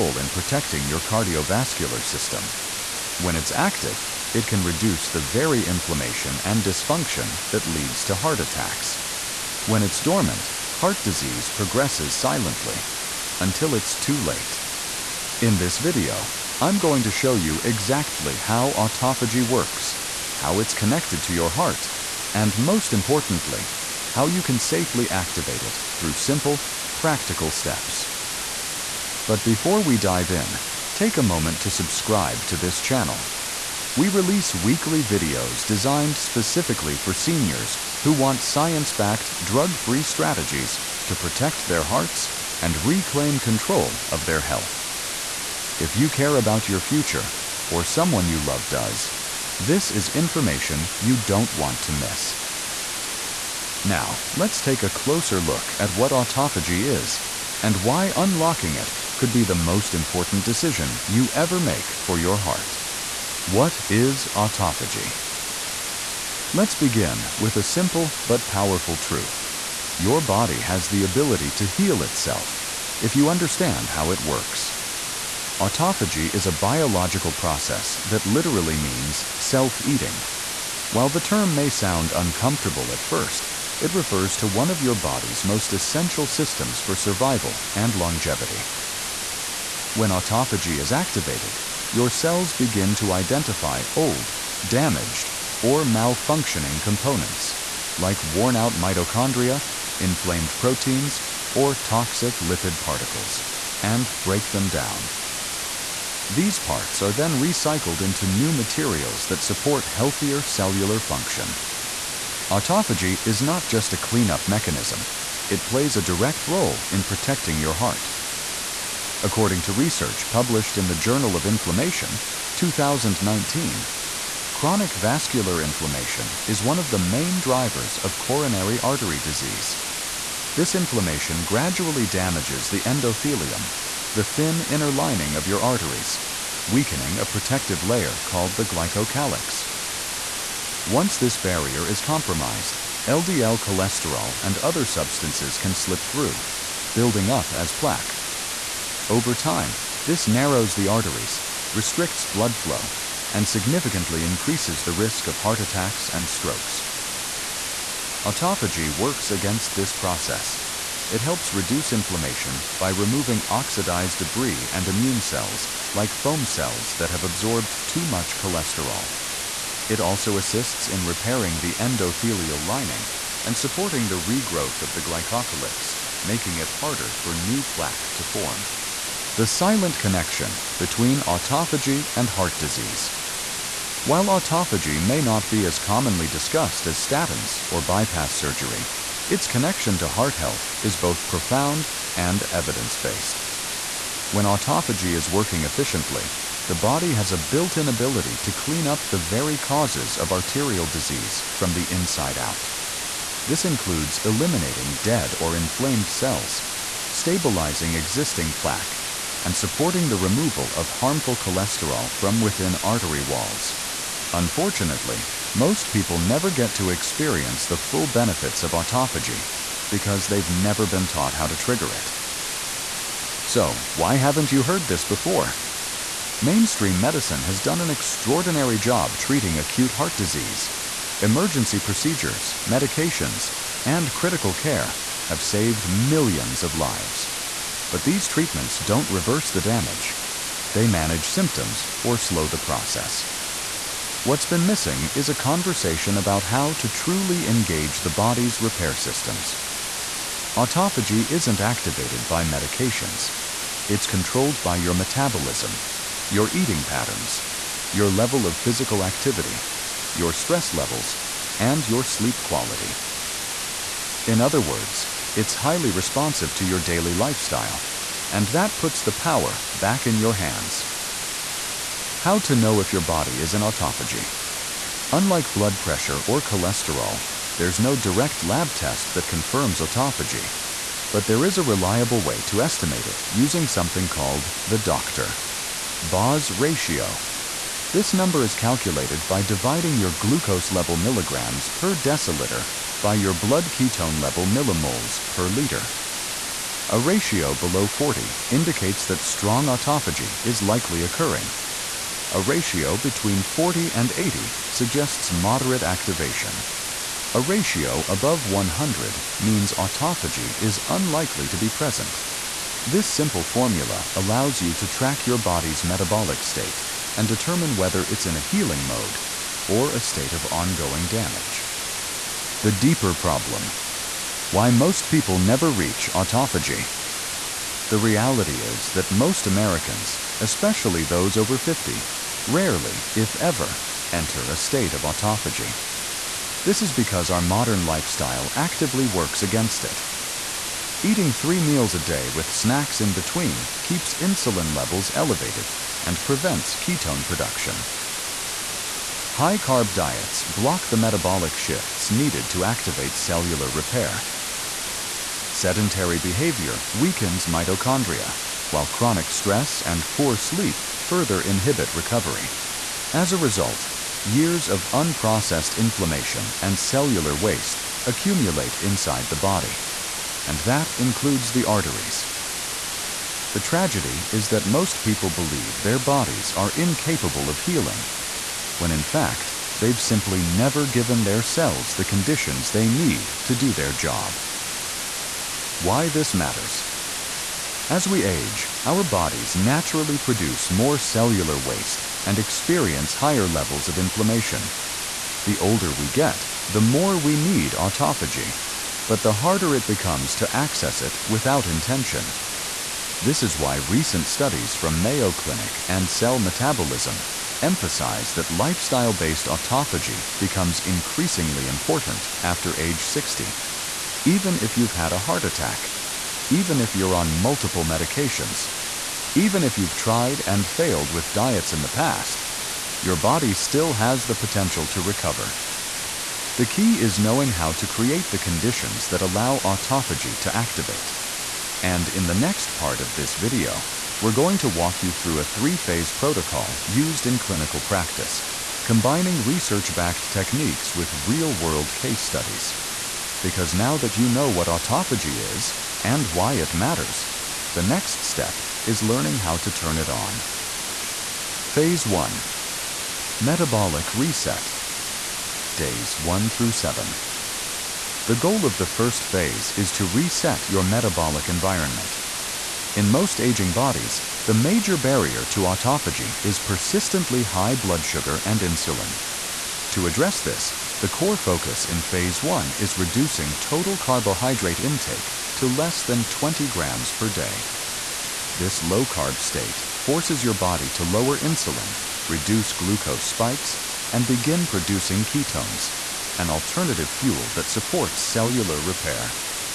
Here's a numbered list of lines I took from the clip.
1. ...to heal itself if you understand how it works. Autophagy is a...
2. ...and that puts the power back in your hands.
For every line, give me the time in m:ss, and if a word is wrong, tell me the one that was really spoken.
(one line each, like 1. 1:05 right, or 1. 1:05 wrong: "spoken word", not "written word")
1. 1:11 right
2. 4:28 right.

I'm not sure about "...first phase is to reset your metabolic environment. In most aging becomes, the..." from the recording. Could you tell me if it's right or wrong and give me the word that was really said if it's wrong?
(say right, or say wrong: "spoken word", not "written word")
wrong: "bodies", not "becomes".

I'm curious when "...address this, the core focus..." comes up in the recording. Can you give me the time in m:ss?
7:50.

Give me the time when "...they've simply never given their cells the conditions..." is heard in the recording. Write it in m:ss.
6:19.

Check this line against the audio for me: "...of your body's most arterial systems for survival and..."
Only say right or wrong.
wrong.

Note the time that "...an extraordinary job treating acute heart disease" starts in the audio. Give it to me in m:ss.
3:47.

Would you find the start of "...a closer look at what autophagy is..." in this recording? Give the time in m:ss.
0:54.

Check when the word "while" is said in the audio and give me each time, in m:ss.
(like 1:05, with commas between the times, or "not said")
1:20, 3:04, 5:58.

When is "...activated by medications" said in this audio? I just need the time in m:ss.
4:11.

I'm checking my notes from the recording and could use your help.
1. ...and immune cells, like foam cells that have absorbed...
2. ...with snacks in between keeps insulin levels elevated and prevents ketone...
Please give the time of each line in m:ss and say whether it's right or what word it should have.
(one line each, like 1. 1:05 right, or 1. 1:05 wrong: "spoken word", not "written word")
1. 2:44 right
2. 5:42 right.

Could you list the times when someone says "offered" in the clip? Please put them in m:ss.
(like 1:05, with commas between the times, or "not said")
not said.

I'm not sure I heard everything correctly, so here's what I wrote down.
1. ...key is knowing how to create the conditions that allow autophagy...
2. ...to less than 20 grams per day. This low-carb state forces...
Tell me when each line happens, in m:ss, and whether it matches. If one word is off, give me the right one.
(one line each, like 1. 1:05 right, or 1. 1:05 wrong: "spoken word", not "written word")
1. 7:06 right
2. 7:55 right.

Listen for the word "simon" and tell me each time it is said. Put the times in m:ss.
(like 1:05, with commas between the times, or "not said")
not said.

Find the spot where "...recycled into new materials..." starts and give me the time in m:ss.
1:47.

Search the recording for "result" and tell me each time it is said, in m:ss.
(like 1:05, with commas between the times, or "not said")
6:03.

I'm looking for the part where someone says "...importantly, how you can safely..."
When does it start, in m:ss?
0:22.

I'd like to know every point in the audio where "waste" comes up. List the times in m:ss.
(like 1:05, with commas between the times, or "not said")
6:07, 6:31.